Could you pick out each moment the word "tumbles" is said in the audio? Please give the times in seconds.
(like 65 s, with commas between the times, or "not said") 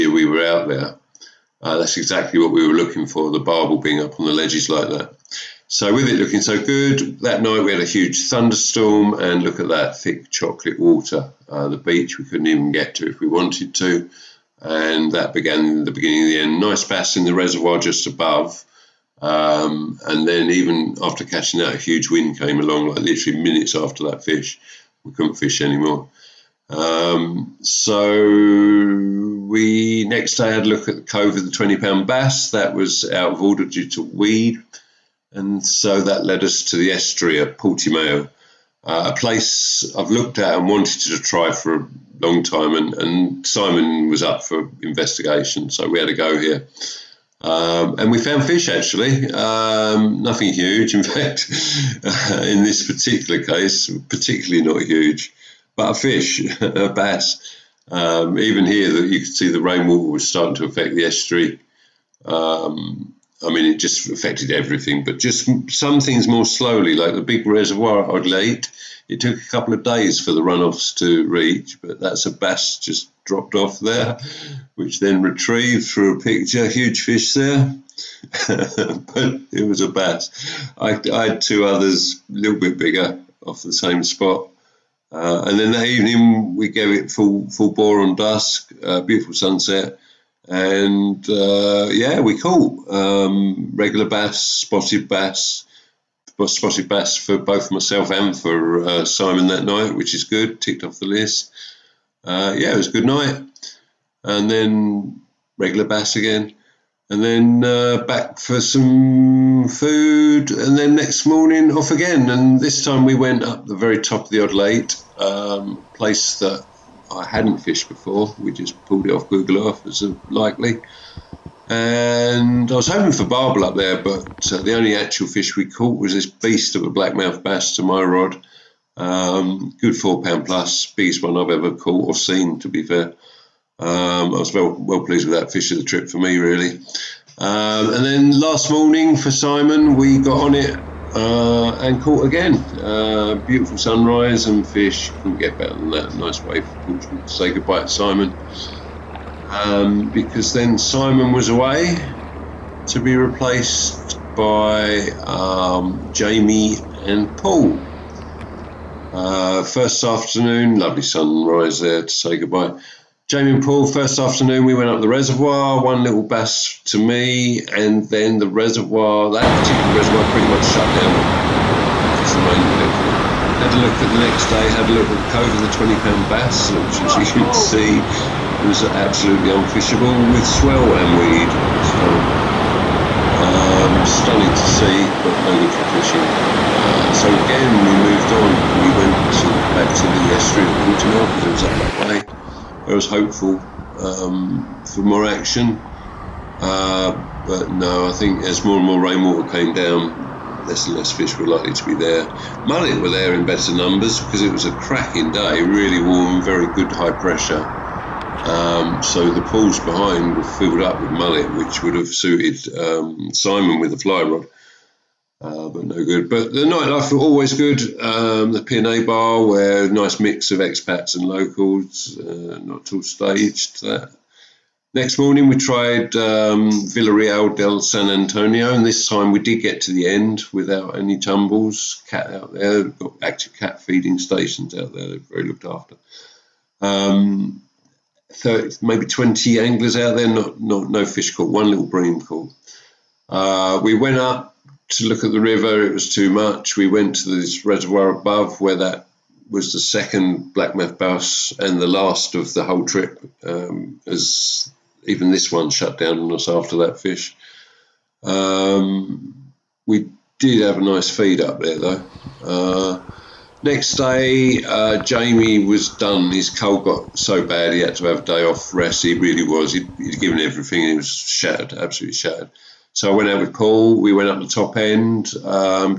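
231 s.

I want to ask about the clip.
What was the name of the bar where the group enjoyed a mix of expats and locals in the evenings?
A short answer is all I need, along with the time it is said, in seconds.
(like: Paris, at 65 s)
P&A bar, at 218 s.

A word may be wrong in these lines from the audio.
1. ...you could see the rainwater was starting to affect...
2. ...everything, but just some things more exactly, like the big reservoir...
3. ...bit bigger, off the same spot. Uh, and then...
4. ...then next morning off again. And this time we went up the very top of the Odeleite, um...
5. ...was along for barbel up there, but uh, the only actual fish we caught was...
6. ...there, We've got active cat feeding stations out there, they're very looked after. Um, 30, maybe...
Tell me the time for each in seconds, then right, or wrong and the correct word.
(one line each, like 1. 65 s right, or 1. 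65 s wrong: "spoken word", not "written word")
1. 59 s right
2. 64 s wrong: "slowly", not "exactly"
3. 82 s right
4. 110 s right
5. 122 s wrong: "hoping", not "along"
6. 232 s right.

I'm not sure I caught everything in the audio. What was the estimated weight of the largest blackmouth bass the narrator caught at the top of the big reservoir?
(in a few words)
4 pounds plus.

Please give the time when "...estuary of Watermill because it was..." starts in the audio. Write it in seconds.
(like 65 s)
190 s.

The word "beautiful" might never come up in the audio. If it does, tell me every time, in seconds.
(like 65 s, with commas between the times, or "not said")
89 s, 143 s.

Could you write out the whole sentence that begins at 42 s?
And, and Simon was up for investigation, so we had a go here.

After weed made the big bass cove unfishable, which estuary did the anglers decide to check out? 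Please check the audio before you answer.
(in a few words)
Portimao.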